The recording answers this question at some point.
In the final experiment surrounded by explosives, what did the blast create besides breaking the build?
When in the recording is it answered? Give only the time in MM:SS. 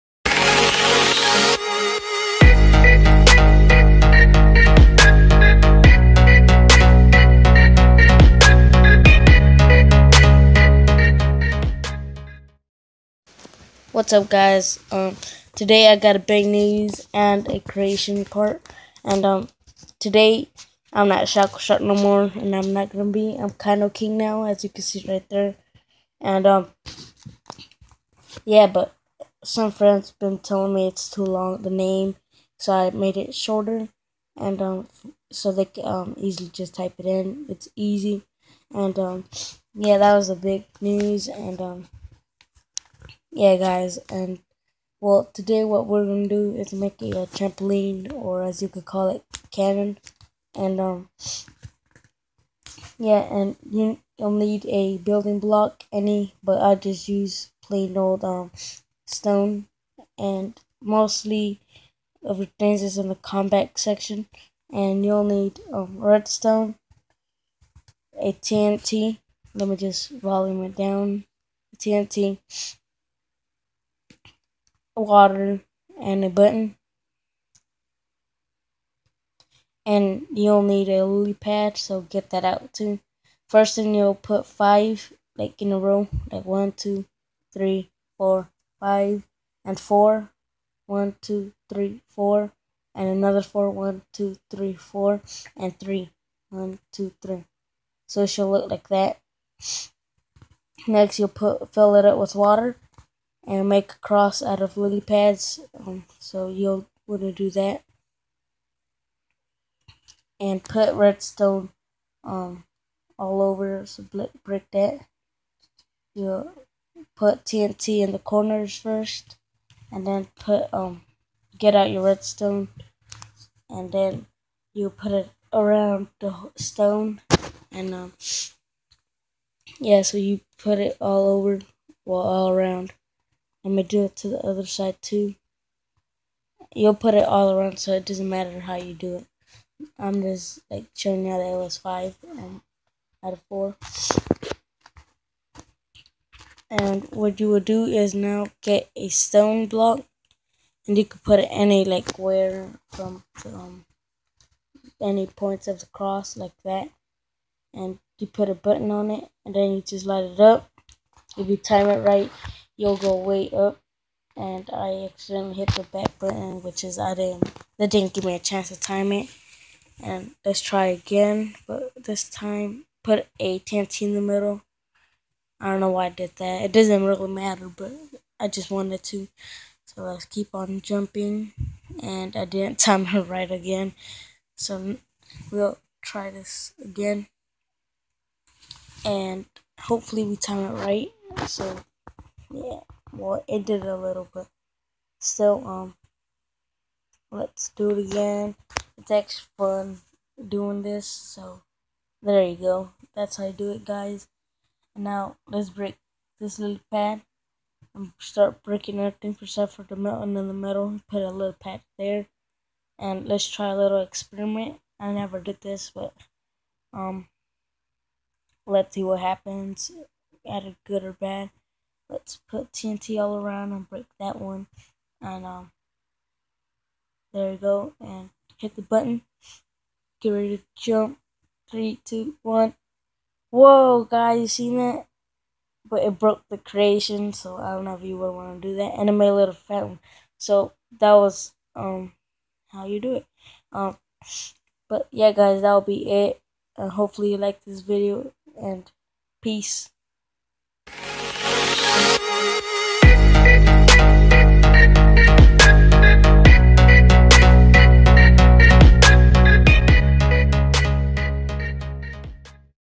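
03:59.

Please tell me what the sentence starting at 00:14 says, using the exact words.
Um, today I got a big news and a creation part.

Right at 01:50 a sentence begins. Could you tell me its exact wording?
And put redstone um, all over, so break that.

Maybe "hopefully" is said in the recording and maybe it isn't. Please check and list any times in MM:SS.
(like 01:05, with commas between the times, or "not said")
03:09, 04:06.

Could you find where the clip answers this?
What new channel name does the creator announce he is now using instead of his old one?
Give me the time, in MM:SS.
00:23.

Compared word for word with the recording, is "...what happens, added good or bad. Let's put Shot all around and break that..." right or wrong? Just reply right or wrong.
wrong.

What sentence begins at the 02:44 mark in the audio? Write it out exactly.
And I accidentally hit the back button, which is I didn't, that didn't give me a chance to time it.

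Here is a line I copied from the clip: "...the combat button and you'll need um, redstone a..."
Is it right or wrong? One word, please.
wrong.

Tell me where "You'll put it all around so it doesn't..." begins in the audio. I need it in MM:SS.
02:16.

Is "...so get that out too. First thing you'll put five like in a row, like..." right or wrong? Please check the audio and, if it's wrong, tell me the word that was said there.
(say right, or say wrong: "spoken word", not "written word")
right.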